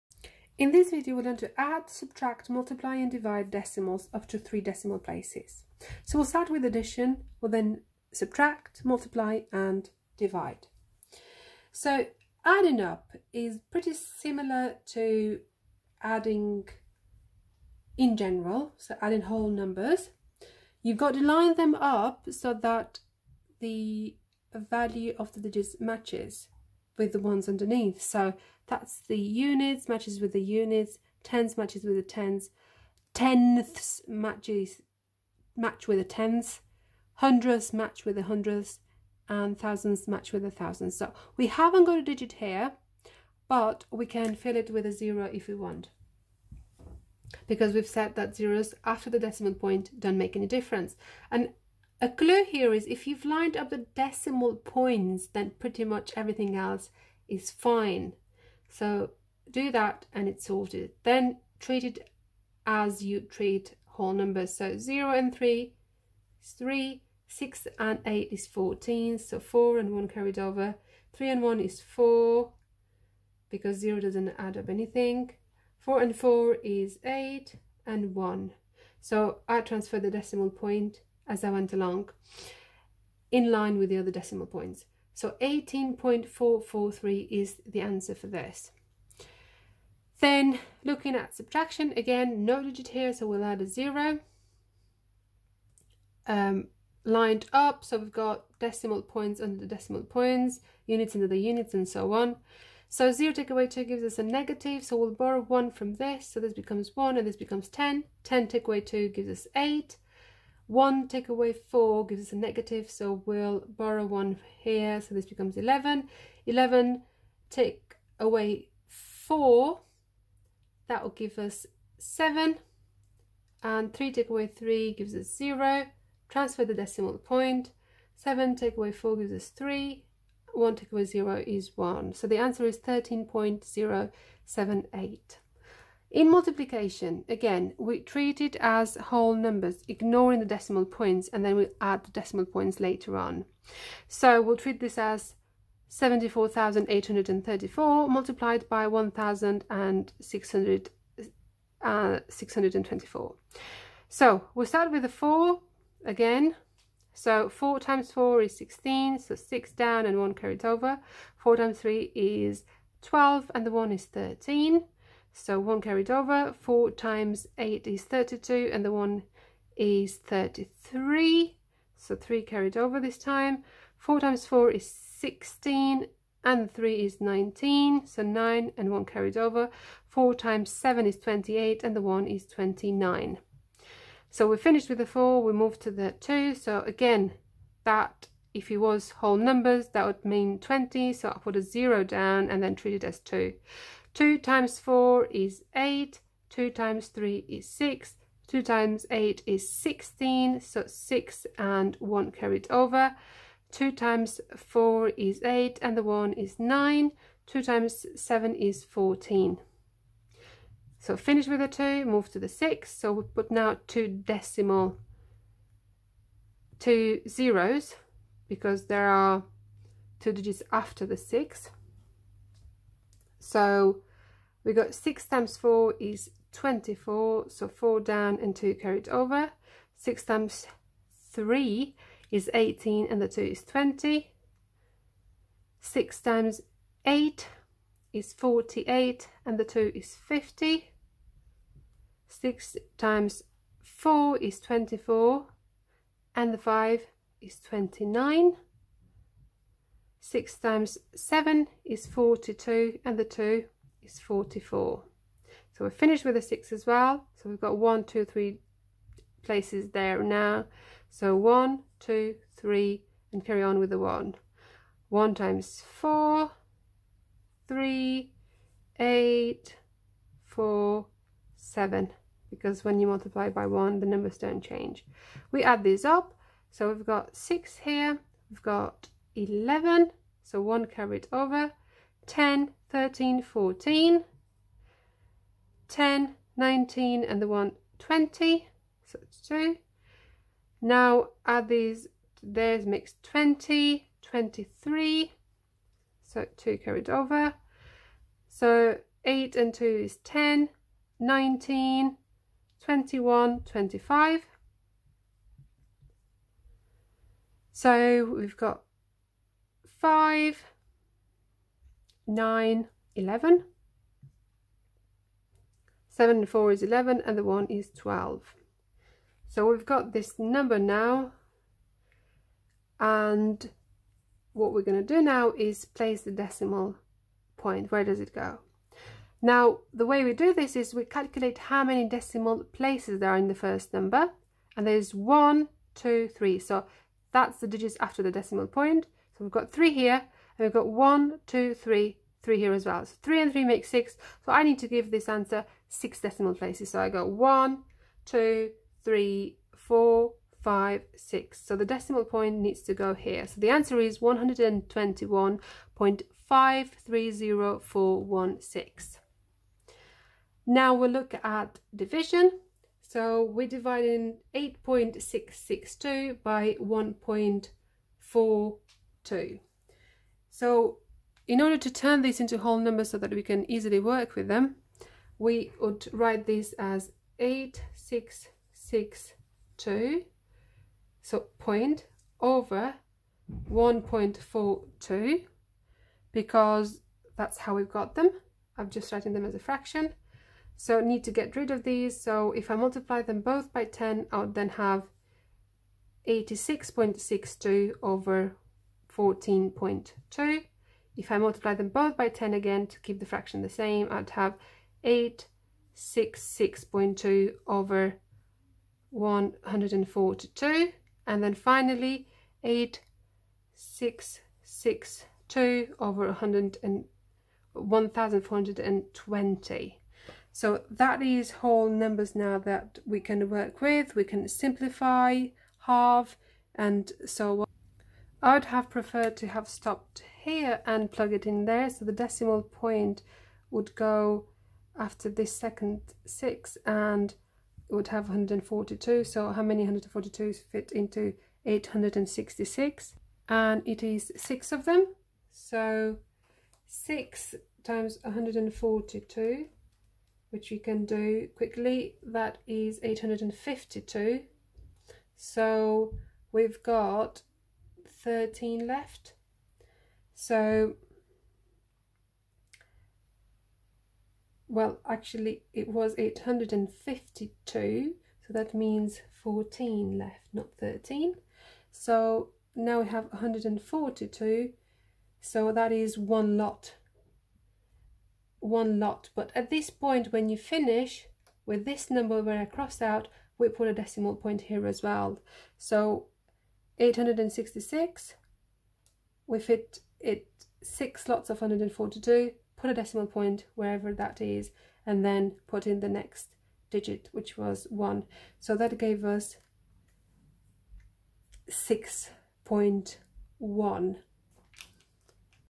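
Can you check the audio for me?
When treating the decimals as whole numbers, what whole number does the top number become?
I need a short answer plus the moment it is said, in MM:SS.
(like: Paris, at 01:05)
74,834, at 02:25.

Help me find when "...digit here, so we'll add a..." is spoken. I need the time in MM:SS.
01:32.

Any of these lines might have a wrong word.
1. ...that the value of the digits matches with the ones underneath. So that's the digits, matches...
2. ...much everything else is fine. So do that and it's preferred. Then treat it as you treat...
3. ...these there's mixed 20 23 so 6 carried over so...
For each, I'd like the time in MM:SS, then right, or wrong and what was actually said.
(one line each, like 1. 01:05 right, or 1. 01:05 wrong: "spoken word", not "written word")
1. 00:22 wrong: "units", not "digits"
2. 00:55 wrong: "sorted", not "preferred"
3. 04:51 wrong: "2", not "6".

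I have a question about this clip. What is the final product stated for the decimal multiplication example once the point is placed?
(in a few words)
121.530416.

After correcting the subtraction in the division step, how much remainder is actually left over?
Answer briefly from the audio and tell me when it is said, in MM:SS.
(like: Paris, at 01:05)
14, at 07:49.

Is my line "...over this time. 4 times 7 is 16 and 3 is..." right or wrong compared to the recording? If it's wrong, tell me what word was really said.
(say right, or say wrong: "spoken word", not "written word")
wrong: "4", not "7".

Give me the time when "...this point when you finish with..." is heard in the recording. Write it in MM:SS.
07:59.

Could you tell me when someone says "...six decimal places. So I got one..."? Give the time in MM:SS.
05:45.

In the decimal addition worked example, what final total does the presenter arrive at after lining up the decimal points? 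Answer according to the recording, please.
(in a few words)
18.443.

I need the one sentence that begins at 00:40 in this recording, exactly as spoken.
So we haven't got a digit here, but we can fill it with a zero if we want.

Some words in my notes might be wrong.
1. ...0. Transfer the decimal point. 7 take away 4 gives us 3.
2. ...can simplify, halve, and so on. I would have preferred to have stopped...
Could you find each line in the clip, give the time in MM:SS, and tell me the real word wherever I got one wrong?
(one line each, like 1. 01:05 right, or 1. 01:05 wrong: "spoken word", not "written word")
1. 02:05 right
2. 07:04 right.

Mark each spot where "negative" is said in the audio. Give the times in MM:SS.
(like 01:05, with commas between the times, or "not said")
01:44, 01:52.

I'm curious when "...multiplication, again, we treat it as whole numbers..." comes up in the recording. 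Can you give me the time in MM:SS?
02:16.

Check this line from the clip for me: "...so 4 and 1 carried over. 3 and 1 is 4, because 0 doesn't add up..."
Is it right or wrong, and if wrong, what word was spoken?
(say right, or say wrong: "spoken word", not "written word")
right.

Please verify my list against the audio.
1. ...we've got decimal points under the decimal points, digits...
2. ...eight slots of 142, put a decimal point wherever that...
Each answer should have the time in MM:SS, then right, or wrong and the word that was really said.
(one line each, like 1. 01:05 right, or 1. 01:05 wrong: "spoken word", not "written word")
1. 01:37 wrong: "units", not "digits"
2. 08:10 wrong: "six", not "eight".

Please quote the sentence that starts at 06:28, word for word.
I'm just writing them as a fraction.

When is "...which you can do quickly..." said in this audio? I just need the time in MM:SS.
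07:30.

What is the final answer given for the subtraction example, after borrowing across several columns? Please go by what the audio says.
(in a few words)
13.078.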